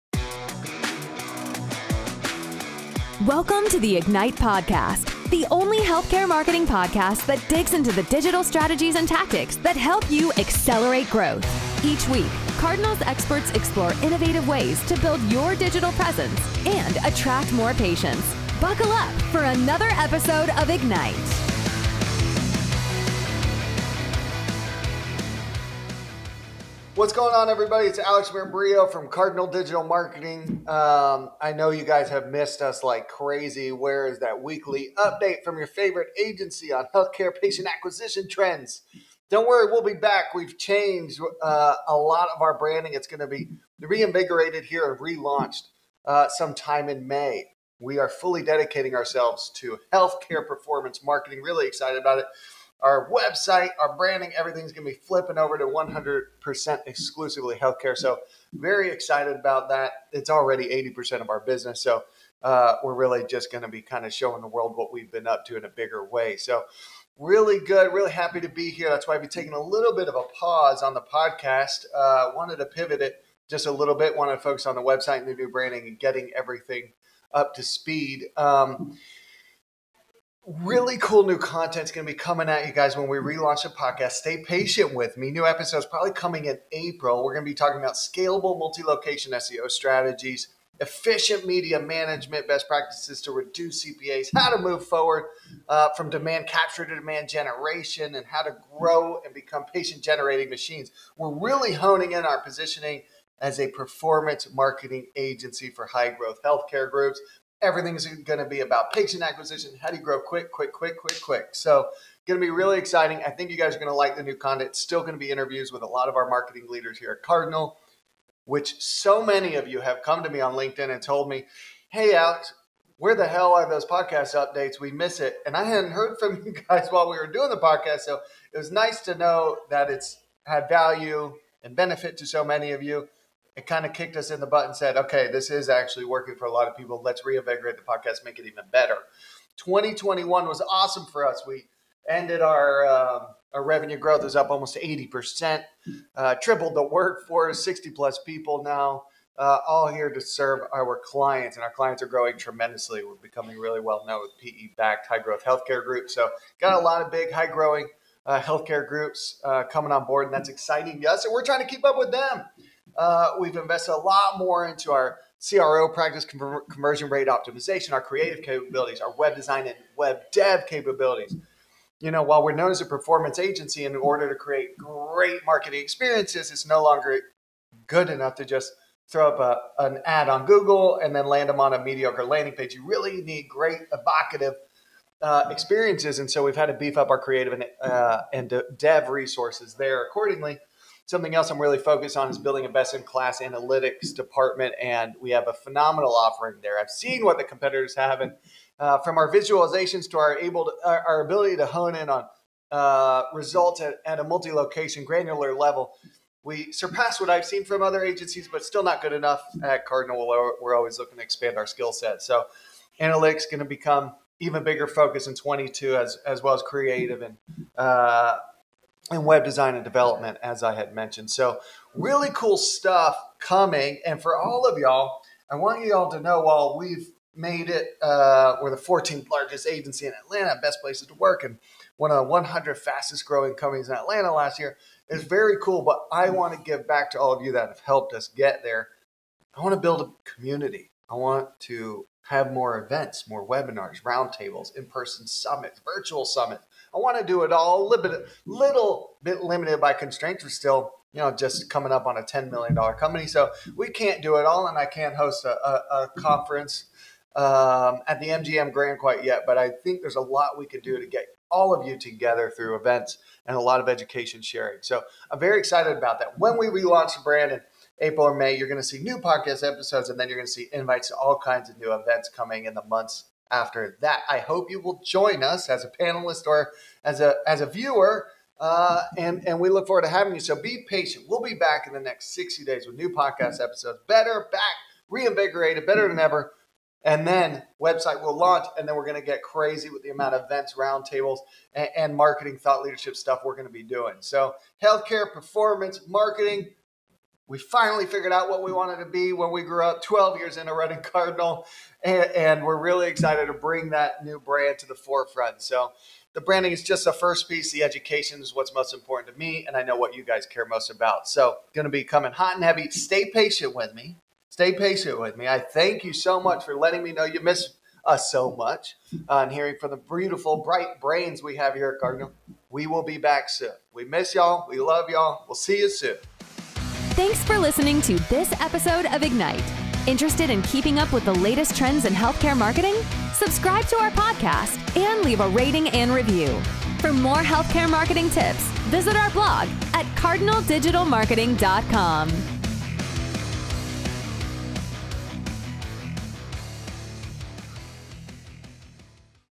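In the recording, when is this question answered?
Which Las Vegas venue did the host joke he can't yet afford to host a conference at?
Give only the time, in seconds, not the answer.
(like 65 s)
258 s.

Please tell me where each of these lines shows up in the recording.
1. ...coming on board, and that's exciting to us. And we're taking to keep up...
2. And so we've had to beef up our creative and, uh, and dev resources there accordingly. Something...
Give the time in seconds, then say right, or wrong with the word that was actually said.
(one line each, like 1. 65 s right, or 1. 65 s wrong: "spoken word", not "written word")
1. 159 s wrong: "trying", not "taking"
2. 186 s right.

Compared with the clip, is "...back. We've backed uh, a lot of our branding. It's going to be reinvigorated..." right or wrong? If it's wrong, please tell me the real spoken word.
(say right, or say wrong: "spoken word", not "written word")
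wrong: "changed", not "backed".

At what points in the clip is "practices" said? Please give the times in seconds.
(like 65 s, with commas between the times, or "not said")
92 s, 165 s.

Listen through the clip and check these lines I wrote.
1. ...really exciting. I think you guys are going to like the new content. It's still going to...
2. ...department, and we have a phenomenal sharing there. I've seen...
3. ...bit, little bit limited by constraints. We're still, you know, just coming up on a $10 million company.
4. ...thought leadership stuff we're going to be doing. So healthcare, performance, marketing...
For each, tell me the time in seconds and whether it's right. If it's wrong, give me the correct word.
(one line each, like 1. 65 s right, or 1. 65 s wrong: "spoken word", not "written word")
1. 112 s right
2. 194 s wrong: "offering", not "sharing"
3. 248 s right
4. 292 s right.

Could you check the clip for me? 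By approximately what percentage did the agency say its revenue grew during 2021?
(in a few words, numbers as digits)
almost 80%.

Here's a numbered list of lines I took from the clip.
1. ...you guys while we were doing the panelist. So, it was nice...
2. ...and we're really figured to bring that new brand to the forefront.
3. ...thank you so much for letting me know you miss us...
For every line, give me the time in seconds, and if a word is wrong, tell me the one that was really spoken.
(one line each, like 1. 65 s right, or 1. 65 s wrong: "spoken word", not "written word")
1. 126 s wrong: "podcast", not "panelist"
2. 302 s wrong: "excited", not "figured"
3. 315 s right.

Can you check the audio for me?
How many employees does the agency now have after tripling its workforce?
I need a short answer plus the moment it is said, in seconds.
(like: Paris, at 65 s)
60 plus, at 147 s.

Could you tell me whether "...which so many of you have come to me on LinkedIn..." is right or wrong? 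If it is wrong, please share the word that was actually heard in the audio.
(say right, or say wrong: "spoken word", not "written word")
right.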